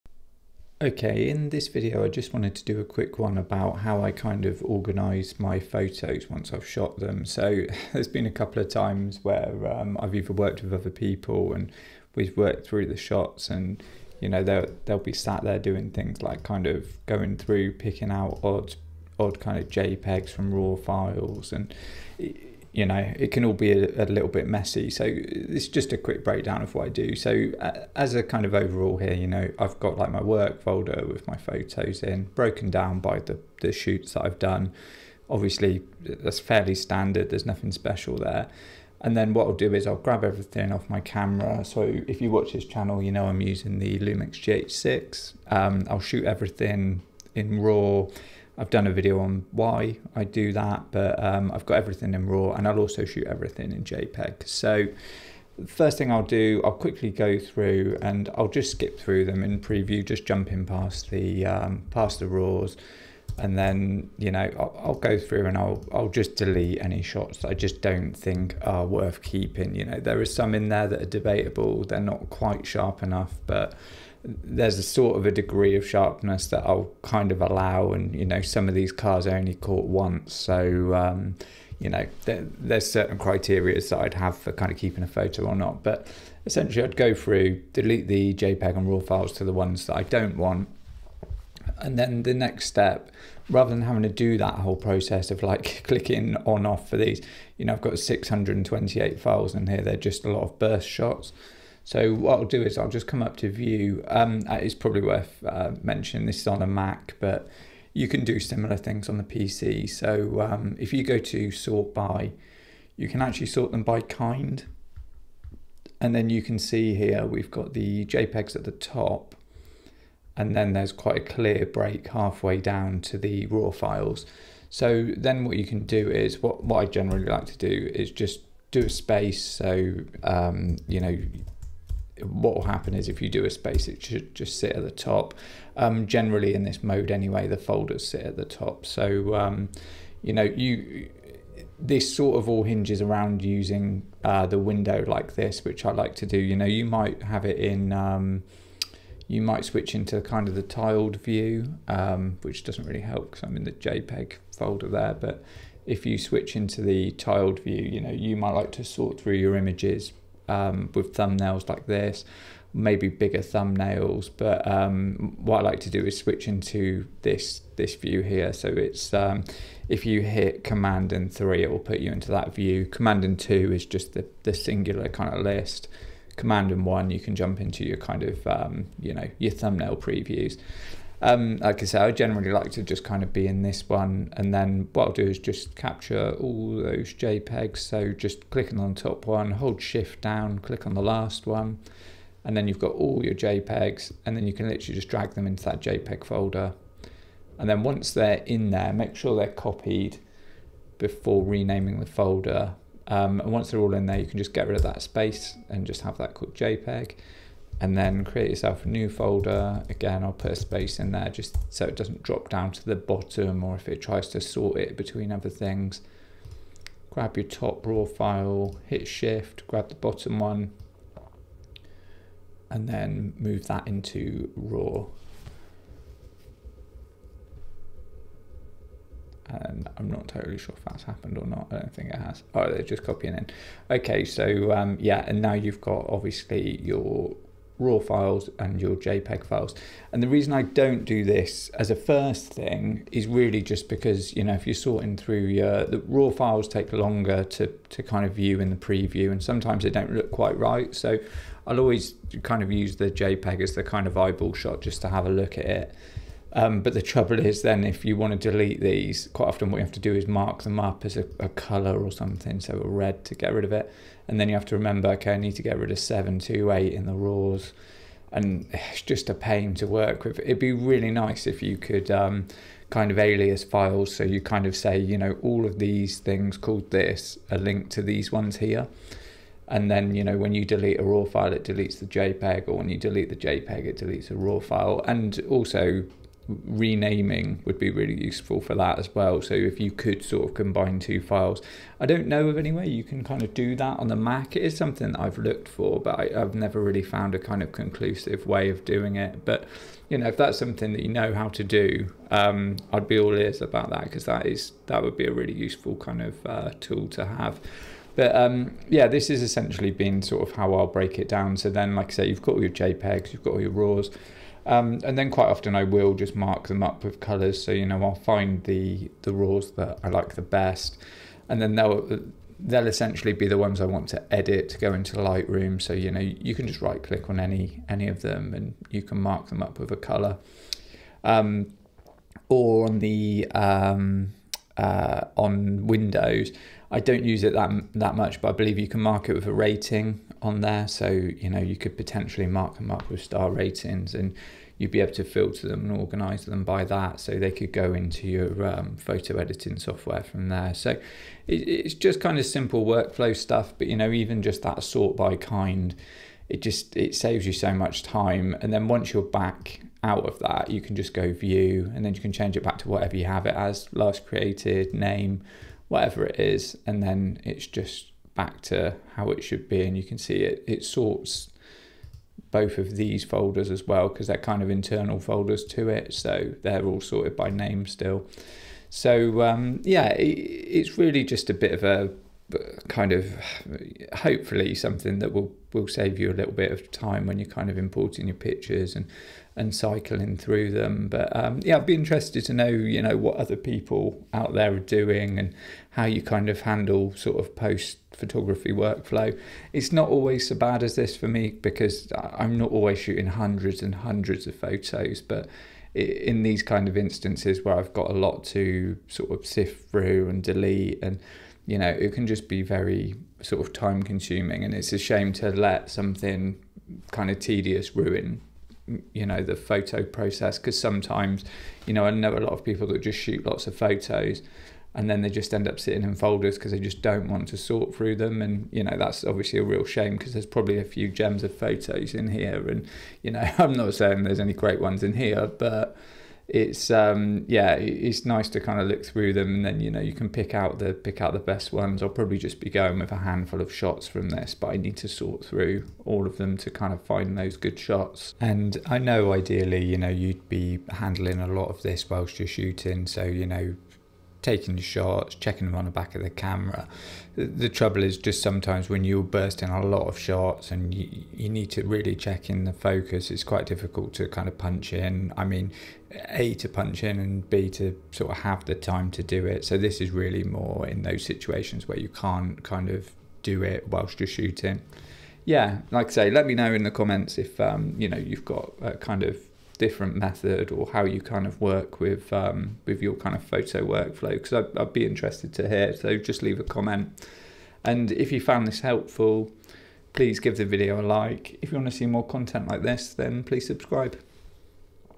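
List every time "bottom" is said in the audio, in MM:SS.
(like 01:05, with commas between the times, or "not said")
03:32, 03:39.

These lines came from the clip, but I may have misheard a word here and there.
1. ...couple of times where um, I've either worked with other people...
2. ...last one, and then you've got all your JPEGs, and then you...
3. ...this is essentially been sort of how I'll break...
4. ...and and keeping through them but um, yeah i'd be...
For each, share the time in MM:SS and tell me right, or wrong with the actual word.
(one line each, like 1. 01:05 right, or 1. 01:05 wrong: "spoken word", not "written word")
1. 00:08 right
2. 03:11 right
3. 05:09 right
4. 06:28 wrong: "cycling", not "keeping".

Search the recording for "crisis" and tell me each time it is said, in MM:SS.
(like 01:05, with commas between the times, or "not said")
not said.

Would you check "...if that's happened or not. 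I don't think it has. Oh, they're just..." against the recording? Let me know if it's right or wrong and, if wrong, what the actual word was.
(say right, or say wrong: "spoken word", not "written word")
right.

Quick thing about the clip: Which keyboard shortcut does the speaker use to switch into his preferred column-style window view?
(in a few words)
Command and three.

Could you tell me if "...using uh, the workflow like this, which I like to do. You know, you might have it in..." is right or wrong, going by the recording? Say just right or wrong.
wrong.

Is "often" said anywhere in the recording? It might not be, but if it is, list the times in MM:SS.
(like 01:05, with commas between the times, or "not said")
04:19, 05:15.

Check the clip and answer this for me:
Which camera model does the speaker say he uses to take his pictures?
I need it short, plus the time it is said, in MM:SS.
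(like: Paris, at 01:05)
Lumix GH6, at 00:43.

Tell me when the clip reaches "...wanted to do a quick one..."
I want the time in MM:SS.
00:02.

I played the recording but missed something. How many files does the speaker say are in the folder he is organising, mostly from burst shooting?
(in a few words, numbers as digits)
628.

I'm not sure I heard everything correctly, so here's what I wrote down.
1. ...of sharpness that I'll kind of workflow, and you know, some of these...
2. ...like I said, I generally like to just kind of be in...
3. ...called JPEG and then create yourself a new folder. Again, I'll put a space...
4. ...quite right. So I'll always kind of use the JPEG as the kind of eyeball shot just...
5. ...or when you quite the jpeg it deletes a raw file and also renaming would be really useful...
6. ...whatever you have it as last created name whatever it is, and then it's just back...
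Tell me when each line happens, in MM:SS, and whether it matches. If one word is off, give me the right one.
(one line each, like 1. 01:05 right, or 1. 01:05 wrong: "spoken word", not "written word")
1. 01:15 wrong: "allow", not "workflow"
2. 03:01 right
3. 03:26 right
4. 04:10 right
5. 04:42 wrong: "delete", not "quite"
6. 06:02 right.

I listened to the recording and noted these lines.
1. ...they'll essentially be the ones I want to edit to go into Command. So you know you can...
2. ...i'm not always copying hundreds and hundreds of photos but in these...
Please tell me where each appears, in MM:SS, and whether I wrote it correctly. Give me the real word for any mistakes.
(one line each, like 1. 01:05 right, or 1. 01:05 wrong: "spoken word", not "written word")
1. 05:22 wrong: "Lightroom", not "Command"
2. 06:42 wrong: "shooting", not "copying".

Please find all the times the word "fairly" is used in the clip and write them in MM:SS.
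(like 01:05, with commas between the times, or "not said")
00:36.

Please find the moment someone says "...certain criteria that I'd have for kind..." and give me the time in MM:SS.
01:22.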